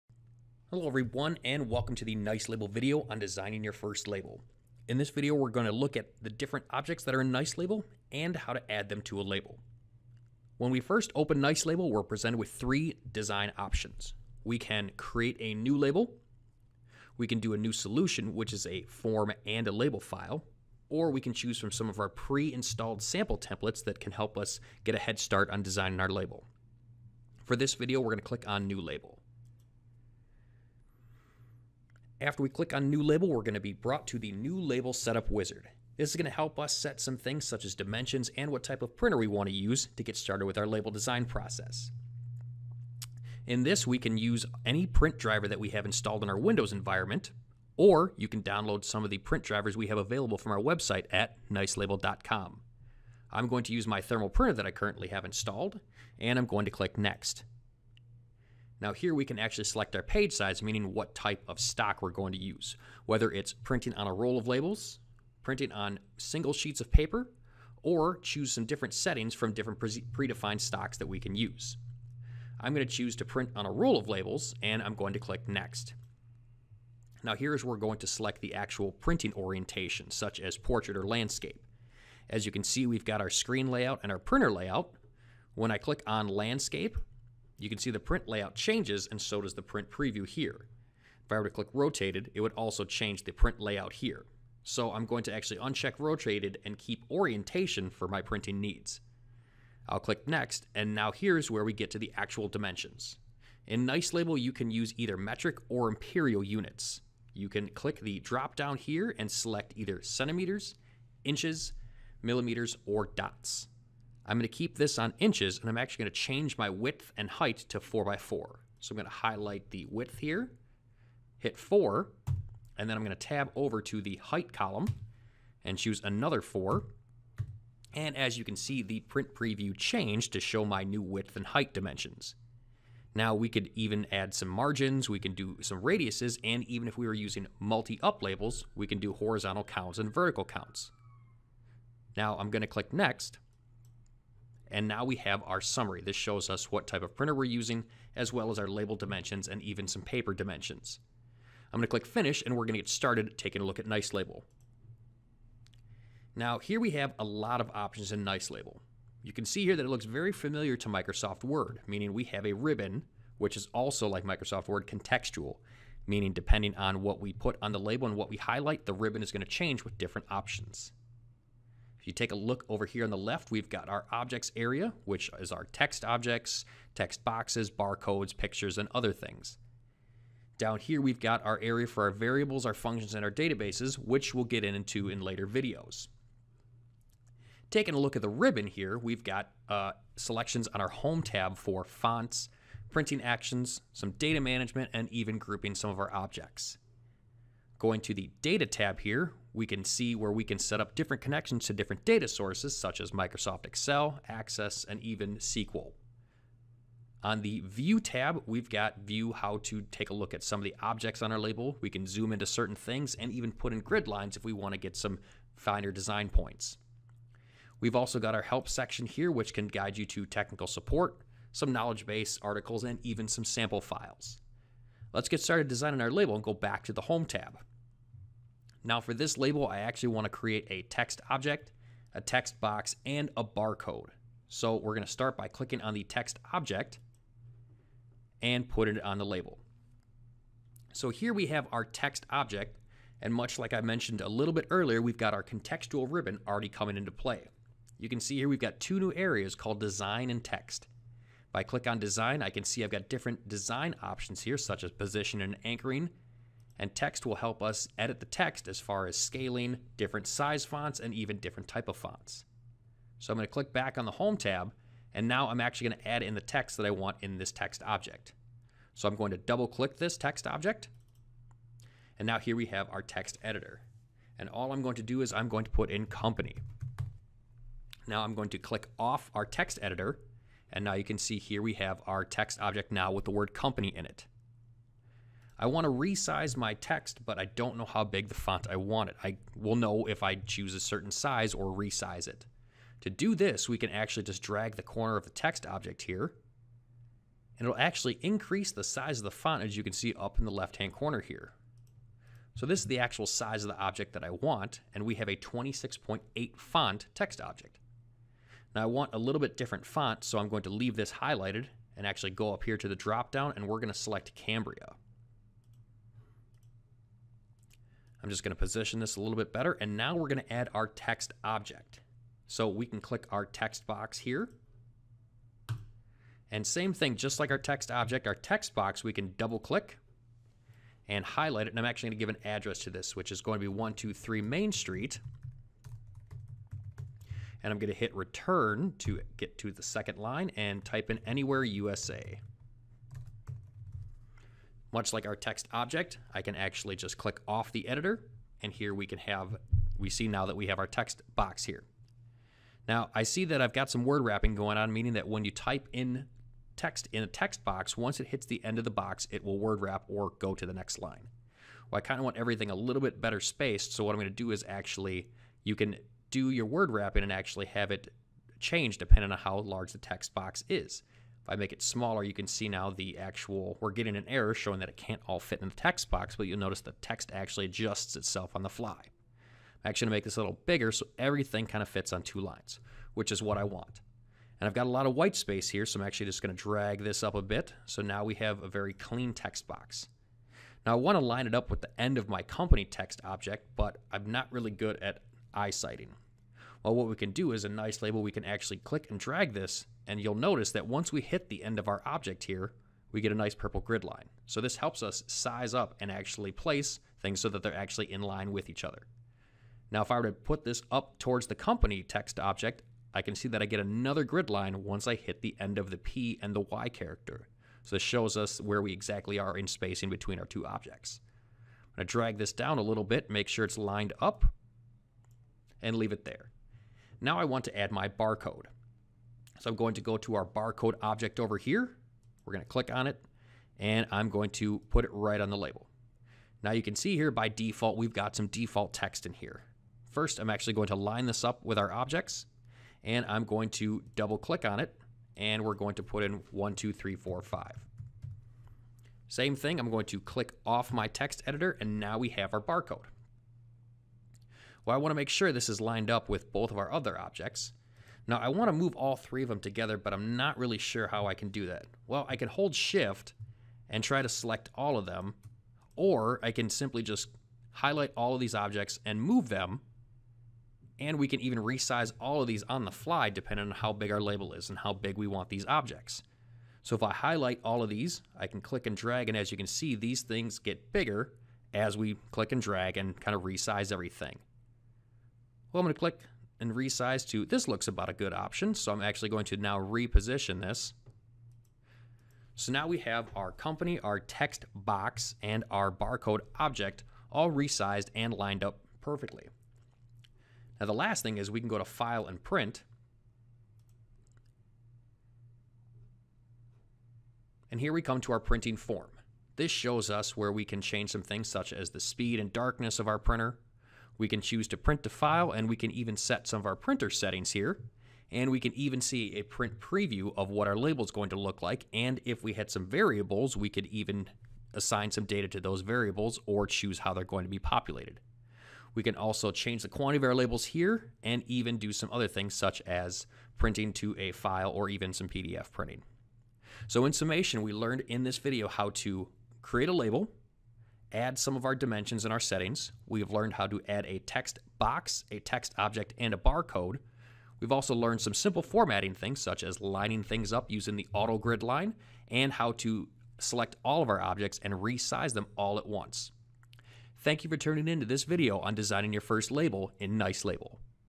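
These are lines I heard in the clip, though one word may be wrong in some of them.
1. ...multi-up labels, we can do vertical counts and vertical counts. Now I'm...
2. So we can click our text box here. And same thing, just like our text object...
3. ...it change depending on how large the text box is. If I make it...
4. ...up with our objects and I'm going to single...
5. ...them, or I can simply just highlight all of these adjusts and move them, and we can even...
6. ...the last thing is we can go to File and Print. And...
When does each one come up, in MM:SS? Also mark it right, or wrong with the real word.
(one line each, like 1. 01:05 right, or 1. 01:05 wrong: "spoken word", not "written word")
1. 02:17 wrong: "horizontal", not "vertical"
2. 05:22 right
3. 06:07 right
4. 07:21 wrong: "double", not "single"
5. 07:45 wrong: "objects", not "adjusts"
6. 08:20 right.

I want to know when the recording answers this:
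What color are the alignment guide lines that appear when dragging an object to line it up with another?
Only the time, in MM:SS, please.
06:43.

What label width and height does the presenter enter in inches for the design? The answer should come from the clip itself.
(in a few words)
4 by 4.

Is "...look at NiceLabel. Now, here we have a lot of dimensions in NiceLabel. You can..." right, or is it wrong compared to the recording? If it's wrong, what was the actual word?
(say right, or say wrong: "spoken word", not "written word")
wrong: "options", not "dimensions".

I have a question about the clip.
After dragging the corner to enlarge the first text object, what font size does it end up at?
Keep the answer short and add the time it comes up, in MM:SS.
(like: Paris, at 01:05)
26.8, at 05:05.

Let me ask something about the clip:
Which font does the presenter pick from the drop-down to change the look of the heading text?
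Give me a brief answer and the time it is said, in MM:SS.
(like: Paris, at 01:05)
Cambria, at 05:14.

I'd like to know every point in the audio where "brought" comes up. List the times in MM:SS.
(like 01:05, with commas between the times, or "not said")
00:33.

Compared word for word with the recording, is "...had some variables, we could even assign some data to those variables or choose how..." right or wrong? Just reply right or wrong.
right.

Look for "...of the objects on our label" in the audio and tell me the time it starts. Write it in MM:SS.
03:30.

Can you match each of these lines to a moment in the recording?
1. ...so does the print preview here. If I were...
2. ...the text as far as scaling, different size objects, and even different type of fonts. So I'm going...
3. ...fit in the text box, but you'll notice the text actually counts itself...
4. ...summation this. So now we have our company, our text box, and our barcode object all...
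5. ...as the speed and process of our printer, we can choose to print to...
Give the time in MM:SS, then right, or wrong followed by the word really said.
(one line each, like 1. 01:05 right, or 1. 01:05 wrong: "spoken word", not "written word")
1. 01:29 right
2. 04:18 wrong: "fonts", not "objects"
3. 06:15 wrong: "adjusts", not "counts"
4. 08:09 wrong: "reposition", not "summation"
5. 08:31 wrong: "darkness", not "process".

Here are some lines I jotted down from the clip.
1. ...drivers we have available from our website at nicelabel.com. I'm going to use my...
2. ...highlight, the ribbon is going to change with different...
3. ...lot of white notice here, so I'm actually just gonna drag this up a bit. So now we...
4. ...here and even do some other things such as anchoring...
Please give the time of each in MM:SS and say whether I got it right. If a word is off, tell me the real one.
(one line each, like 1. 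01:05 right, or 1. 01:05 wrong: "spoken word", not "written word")
1. 00:49 right
2. 02:48 right
3. 06:24 wrong: "space", not "notice"
4. 08:50 wrong: "printing", not "anchoring".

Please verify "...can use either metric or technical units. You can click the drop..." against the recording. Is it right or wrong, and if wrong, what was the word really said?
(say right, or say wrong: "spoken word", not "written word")
wrong: "imperial", not "technical".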